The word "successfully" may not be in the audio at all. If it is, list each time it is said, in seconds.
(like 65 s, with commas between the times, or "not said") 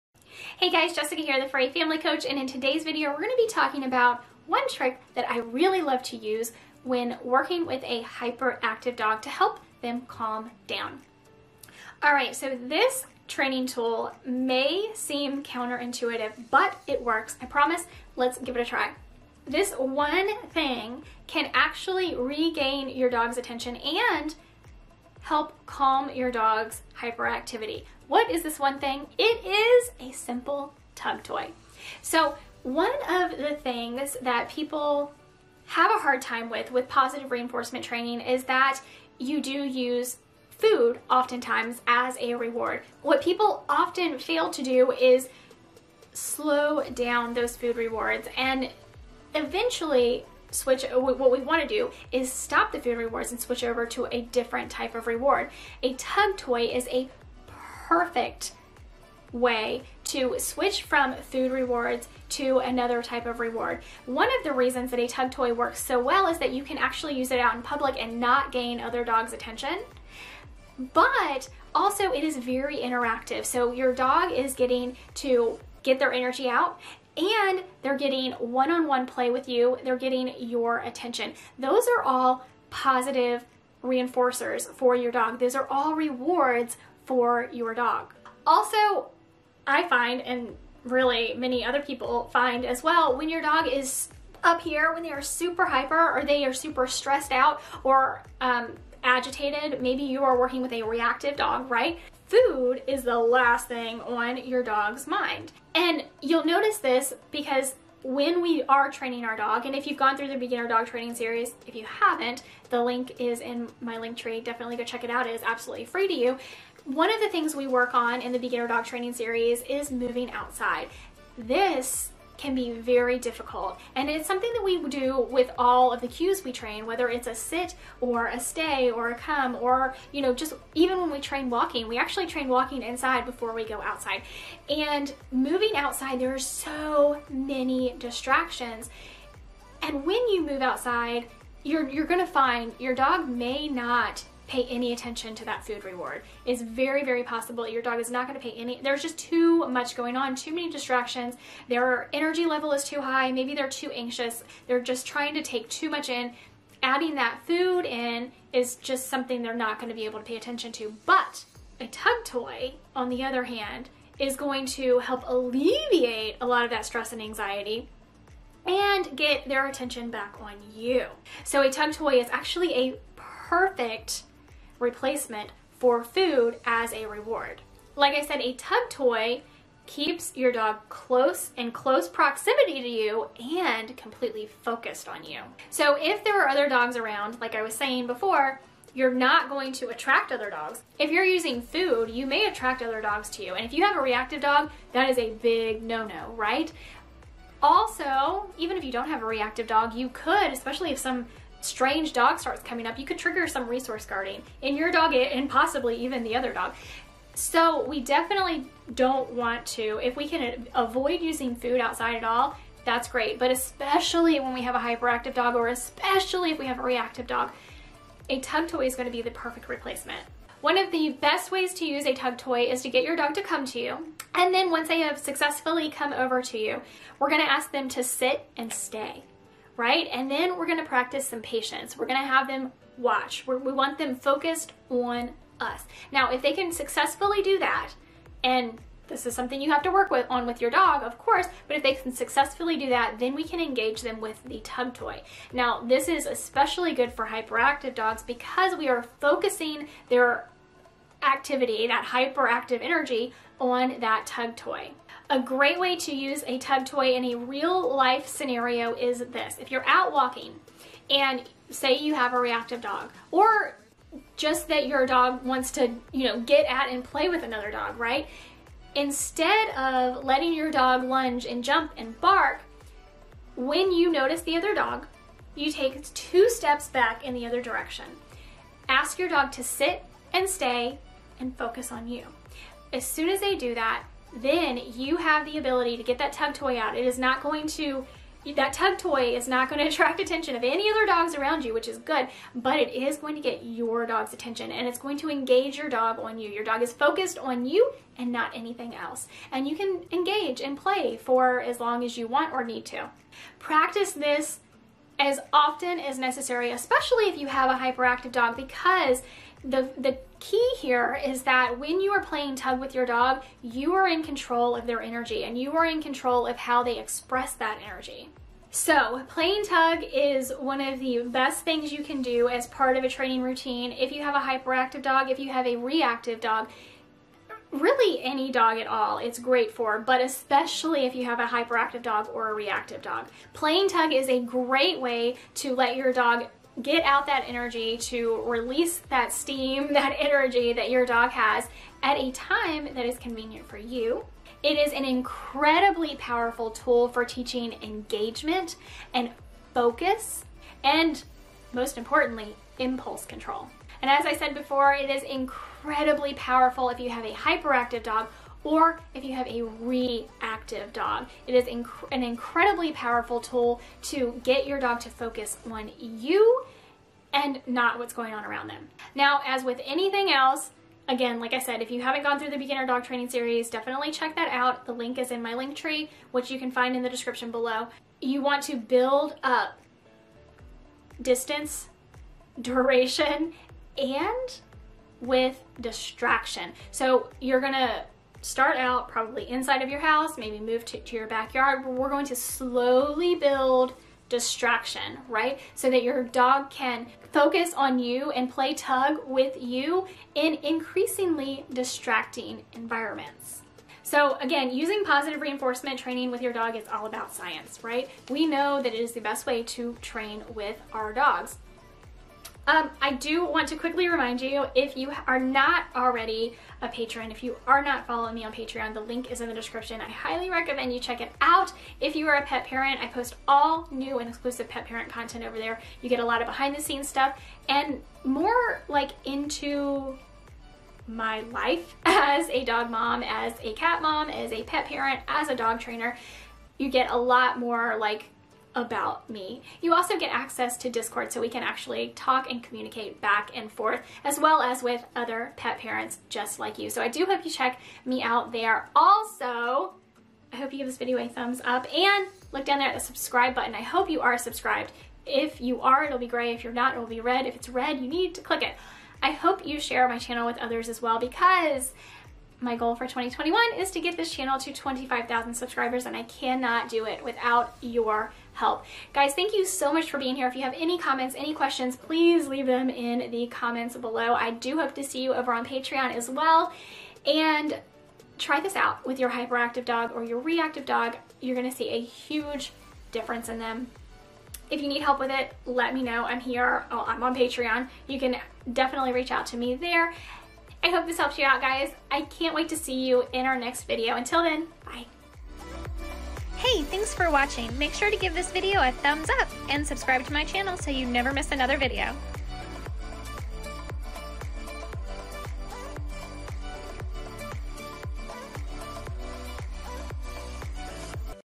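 225 s, 236 s, 242 s.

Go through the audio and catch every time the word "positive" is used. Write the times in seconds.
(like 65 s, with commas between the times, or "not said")
36 s, 82 s, 405 s.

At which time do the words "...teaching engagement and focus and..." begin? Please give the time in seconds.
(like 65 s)
347 s.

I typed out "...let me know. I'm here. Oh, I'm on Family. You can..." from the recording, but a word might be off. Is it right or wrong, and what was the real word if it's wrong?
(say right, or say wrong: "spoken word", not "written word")
wrong: "Patreon", not "Family".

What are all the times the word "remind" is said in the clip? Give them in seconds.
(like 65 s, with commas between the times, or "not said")
414 s.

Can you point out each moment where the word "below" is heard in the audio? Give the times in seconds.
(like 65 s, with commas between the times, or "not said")
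377 s, 473 s.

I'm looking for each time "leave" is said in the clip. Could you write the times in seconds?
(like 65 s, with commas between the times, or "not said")
472 s.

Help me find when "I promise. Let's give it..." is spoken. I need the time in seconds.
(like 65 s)
17 s.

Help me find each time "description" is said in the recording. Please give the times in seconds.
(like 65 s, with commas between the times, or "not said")
377 s, 419 s.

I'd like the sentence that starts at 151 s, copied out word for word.
Their energy level is too high.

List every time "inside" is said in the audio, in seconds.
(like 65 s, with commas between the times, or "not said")
132 s, 389 s.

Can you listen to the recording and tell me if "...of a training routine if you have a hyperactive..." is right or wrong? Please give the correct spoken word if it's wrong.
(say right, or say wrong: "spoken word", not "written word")
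right.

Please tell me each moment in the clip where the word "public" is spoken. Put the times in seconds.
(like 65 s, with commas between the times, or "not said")
67 s.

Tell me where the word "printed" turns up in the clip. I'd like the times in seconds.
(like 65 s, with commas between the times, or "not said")
not said.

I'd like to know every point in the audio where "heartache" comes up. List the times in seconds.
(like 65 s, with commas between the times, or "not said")
not said.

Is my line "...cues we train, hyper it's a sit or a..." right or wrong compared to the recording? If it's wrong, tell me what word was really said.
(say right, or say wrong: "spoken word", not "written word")
wrong: "whether", not "hyper".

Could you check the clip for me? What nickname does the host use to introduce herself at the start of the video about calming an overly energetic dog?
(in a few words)
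Furry Family Coach.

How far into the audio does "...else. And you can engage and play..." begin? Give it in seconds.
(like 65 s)
298 s.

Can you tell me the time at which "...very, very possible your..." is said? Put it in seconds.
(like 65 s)
146 s.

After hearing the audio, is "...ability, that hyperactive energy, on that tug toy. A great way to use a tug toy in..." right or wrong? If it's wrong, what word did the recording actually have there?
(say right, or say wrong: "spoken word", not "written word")
wrong: "activity", not "ability".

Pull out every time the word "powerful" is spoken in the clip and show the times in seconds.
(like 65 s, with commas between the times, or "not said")
346 s, 356 s, 362 s.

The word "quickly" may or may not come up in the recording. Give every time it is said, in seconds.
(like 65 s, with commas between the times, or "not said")
413 s.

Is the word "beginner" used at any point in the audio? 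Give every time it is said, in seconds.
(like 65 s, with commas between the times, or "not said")
110 s, 118 s, 372 s.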